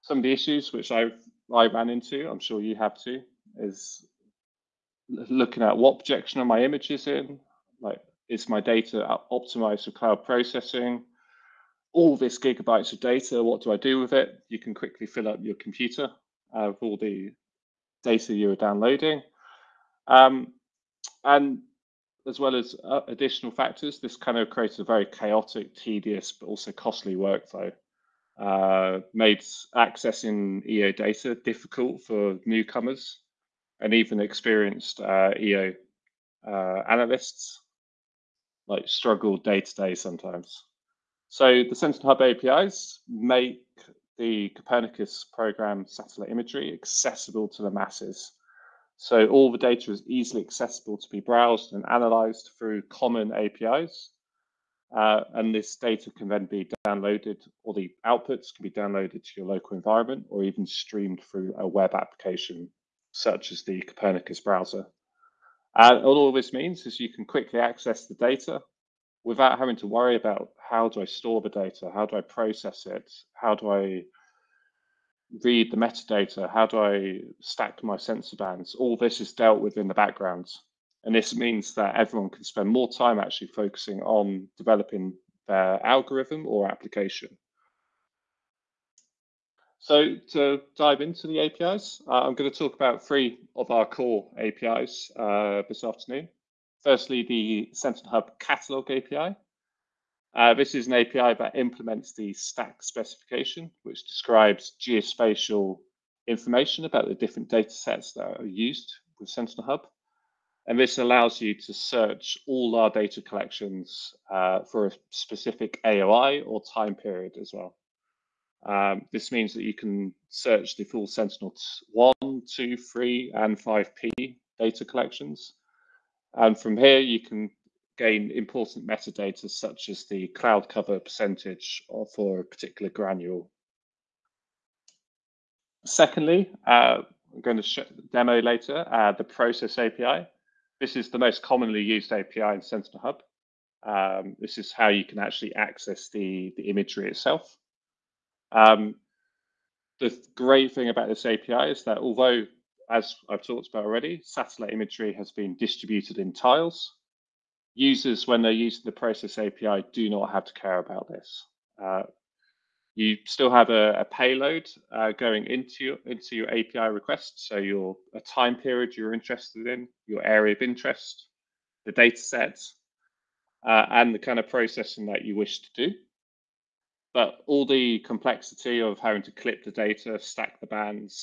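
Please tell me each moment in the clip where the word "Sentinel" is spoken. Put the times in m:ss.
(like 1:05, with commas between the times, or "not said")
0:41, 1:37, 1:49, 2:01, 2:22.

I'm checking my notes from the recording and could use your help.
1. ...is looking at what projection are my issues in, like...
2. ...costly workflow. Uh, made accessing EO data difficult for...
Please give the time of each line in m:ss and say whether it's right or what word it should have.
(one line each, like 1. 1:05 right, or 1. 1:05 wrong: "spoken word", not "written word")
1. 0:03 wrong: "images", not "issues"
2. 0:26 right.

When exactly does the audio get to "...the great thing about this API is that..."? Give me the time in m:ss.
2:29.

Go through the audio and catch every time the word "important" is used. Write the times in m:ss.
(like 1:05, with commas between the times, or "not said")
2:08.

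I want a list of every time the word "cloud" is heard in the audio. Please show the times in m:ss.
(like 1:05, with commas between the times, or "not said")
0:09, 2:10.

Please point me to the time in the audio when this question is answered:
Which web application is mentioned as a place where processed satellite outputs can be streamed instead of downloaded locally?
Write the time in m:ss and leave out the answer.
1:03.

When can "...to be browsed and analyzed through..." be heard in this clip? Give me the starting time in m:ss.
0:50.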